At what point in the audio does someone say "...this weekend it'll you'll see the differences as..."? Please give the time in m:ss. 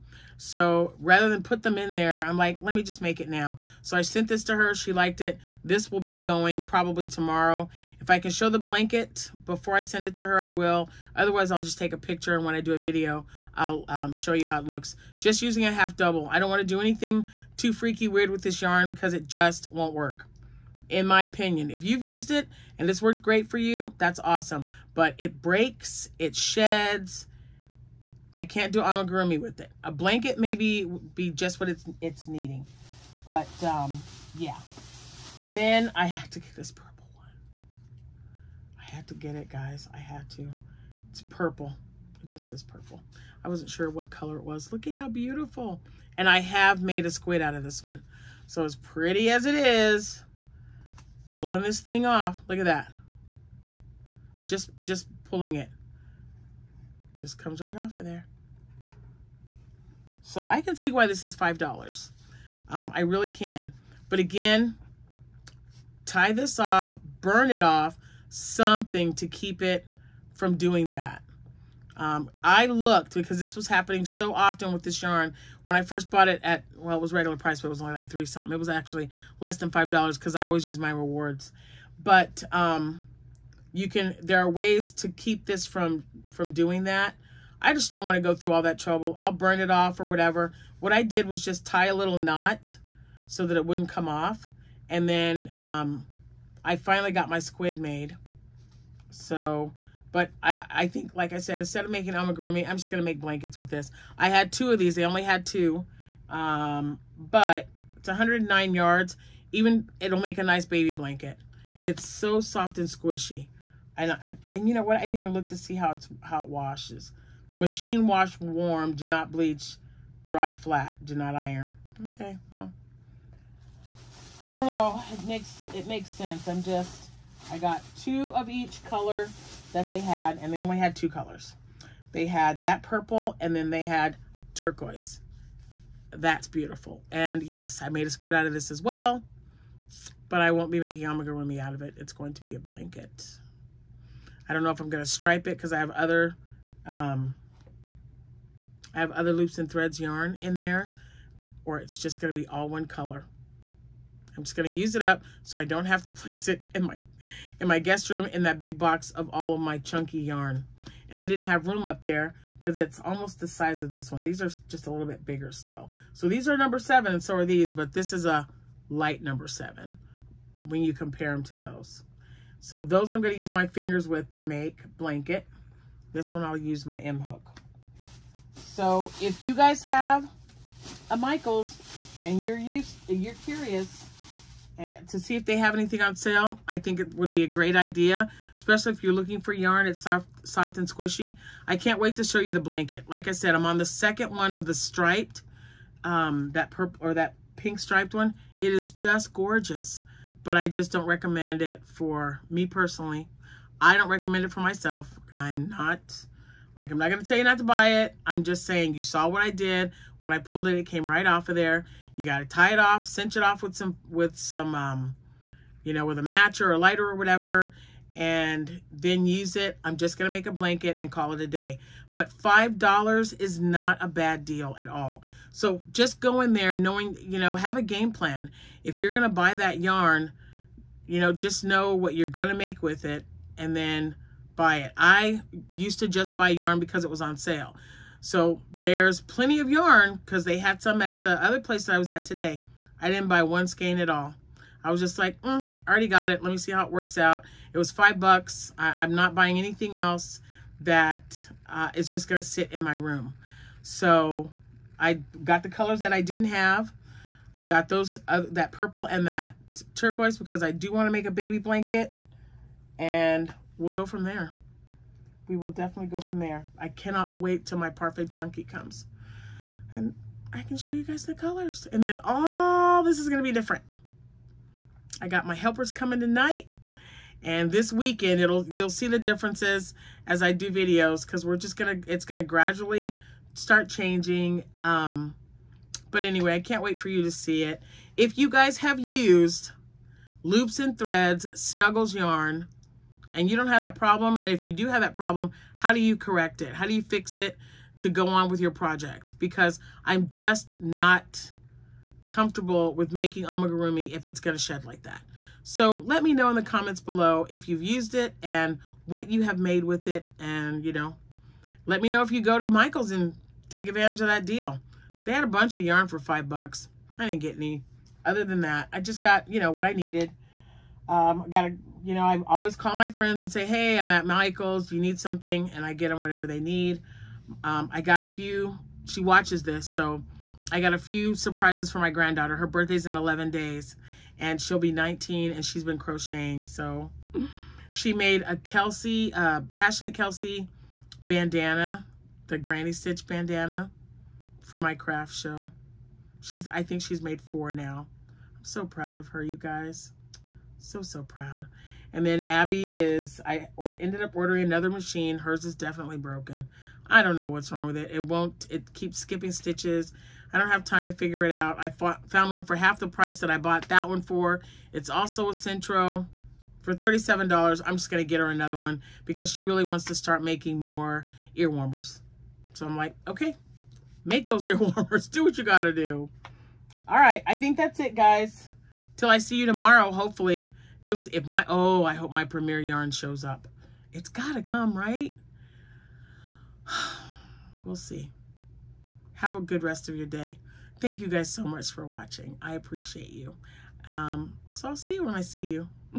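4:37.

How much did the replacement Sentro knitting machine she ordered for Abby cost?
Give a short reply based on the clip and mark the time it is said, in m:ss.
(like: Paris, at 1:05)
$37, at 6:06.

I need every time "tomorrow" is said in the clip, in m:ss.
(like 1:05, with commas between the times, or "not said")
0:07, 6:19.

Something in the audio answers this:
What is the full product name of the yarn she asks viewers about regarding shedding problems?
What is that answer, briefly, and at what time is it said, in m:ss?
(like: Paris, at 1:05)
Loops and Threads Snuggles, at 4:50.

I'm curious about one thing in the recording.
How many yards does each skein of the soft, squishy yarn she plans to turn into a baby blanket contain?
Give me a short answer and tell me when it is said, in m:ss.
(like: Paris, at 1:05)
109, at 1:48.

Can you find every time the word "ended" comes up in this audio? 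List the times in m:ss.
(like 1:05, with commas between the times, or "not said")
5:53.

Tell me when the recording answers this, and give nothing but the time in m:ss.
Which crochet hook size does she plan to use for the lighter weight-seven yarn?
2:56.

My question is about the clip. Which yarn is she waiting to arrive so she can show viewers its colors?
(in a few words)
Parfait Chunky.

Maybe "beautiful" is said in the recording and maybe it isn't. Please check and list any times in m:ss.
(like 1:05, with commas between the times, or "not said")
0:45, 2:16.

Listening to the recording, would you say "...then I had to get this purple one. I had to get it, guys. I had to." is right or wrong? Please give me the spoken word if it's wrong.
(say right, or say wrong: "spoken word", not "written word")
right.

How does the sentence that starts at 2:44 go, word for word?
These are just a little bit bigger still.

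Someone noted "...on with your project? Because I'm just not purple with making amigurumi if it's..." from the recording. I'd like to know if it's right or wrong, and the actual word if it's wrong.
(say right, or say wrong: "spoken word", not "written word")
wrong: "comfortable", not "purple".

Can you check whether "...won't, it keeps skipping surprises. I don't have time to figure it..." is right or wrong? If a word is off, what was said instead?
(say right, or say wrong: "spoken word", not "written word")
wrong: "stitches", not "surprises".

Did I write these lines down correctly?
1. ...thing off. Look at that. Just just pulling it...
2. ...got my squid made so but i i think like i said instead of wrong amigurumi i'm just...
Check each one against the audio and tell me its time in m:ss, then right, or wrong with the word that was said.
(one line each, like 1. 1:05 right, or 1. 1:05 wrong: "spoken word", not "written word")
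1. 0:51 right
2. 1:37 wrong: "making", not "wrong".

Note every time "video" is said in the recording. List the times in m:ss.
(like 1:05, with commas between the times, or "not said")
0:12, 4:40.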